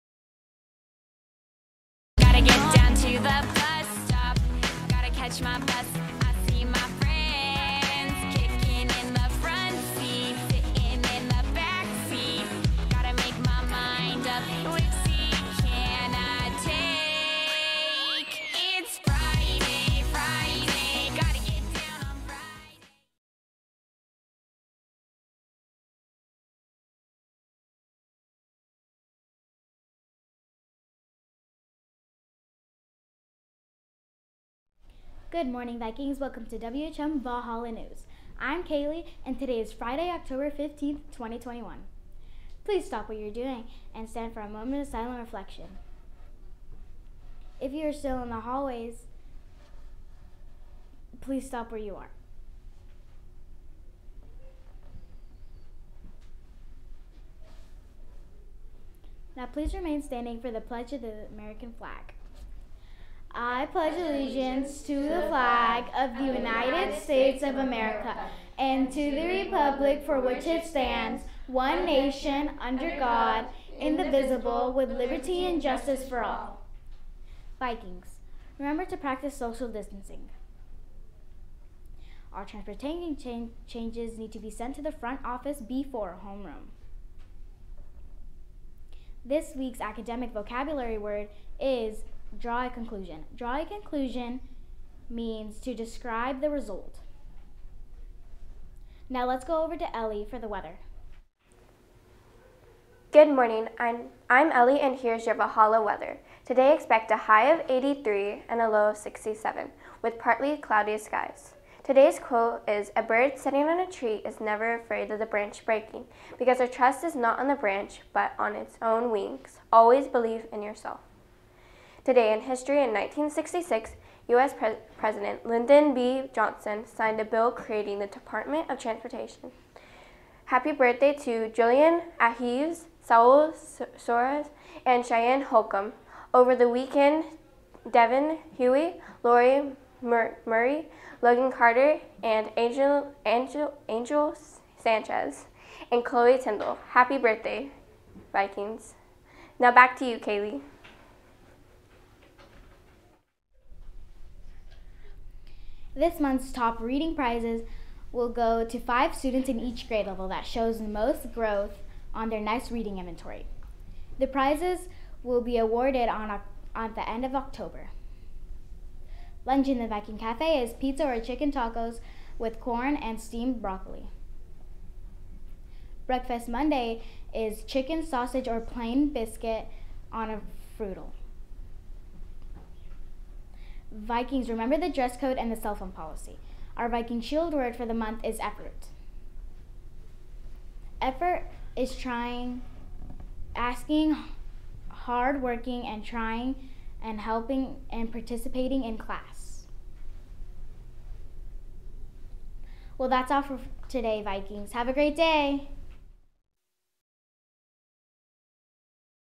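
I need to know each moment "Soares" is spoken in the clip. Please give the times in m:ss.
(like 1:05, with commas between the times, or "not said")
2:13.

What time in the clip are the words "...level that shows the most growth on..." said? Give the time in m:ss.
2:40.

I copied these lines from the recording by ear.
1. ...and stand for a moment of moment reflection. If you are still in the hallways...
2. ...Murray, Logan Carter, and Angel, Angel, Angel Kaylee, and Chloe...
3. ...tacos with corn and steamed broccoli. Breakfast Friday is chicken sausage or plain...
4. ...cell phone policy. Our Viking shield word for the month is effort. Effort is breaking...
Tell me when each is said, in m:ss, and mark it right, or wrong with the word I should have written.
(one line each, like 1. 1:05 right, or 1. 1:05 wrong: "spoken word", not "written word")
1. 0:43 wrong: "silent", not "moment"
2. 2:20 wrong: "Sanchez", not "Kaylee"
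3. 2:51 wrong: "Monday", not "Friday"
4. 3:05 wrong: "trying", not "breaking".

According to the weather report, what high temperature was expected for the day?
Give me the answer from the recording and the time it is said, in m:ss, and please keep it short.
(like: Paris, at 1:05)
83, at 1:47.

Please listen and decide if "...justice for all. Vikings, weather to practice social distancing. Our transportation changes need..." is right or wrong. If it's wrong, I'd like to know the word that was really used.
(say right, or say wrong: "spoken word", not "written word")
wrong: "remember", not "weather".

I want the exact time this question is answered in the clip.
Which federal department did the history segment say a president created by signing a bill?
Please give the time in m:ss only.
2:08.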